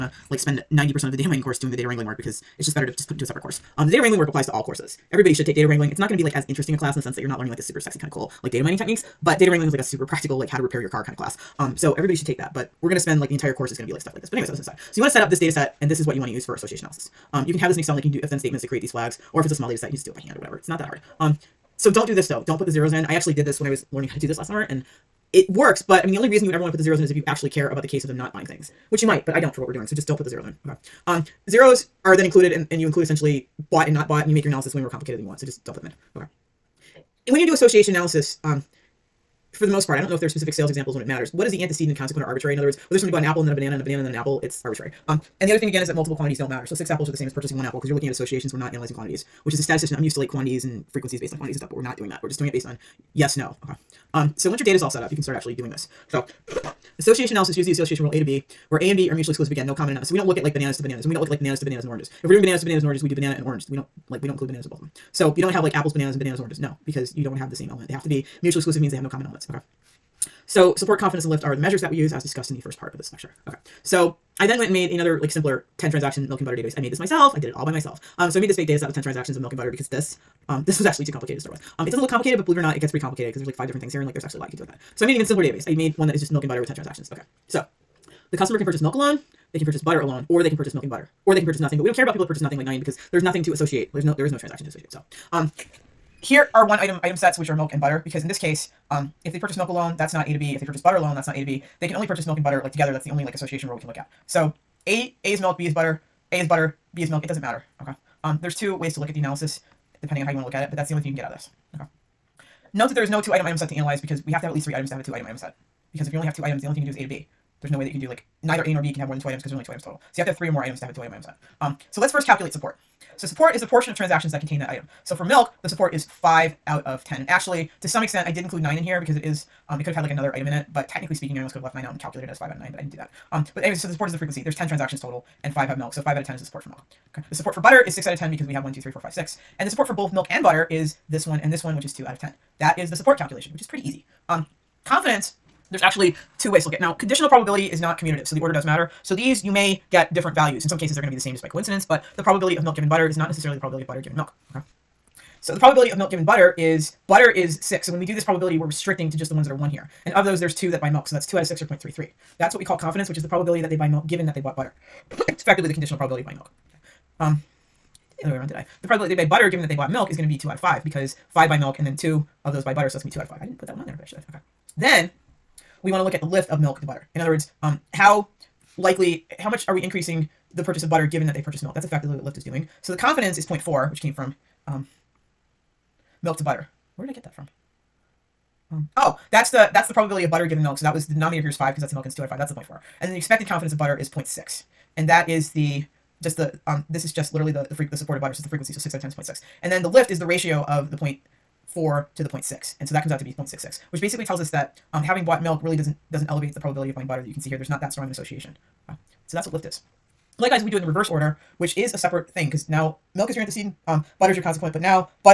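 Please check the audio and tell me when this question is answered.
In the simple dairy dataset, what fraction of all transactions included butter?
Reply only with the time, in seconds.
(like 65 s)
137 s.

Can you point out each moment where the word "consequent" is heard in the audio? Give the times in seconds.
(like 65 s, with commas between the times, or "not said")
41 s, 214 s.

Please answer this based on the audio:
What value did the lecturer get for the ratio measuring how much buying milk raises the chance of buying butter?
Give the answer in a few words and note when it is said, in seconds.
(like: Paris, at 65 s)
0.66, at 203 s.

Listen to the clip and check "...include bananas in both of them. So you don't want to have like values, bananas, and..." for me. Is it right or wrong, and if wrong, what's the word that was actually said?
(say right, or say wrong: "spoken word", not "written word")
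wrong: "apples", not "values".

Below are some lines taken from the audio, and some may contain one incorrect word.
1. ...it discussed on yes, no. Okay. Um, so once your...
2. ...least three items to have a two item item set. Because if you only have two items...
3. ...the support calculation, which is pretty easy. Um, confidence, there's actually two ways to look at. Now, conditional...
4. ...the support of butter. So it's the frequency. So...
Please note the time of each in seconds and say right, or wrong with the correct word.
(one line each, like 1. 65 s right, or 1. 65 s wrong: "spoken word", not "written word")
1. 52 s wrong: "based", not "discussed"
2. 114 s right
3. 142 s right
4. 197 s right.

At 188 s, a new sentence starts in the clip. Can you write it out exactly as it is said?
Um, oh, that's the that's the probability of butter given milk.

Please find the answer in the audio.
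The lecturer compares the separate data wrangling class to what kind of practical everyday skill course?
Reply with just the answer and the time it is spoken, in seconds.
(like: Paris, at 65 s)
How to repair your car, at 10 s.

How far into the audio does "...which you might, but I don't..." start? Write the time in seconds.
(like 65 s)
28 s.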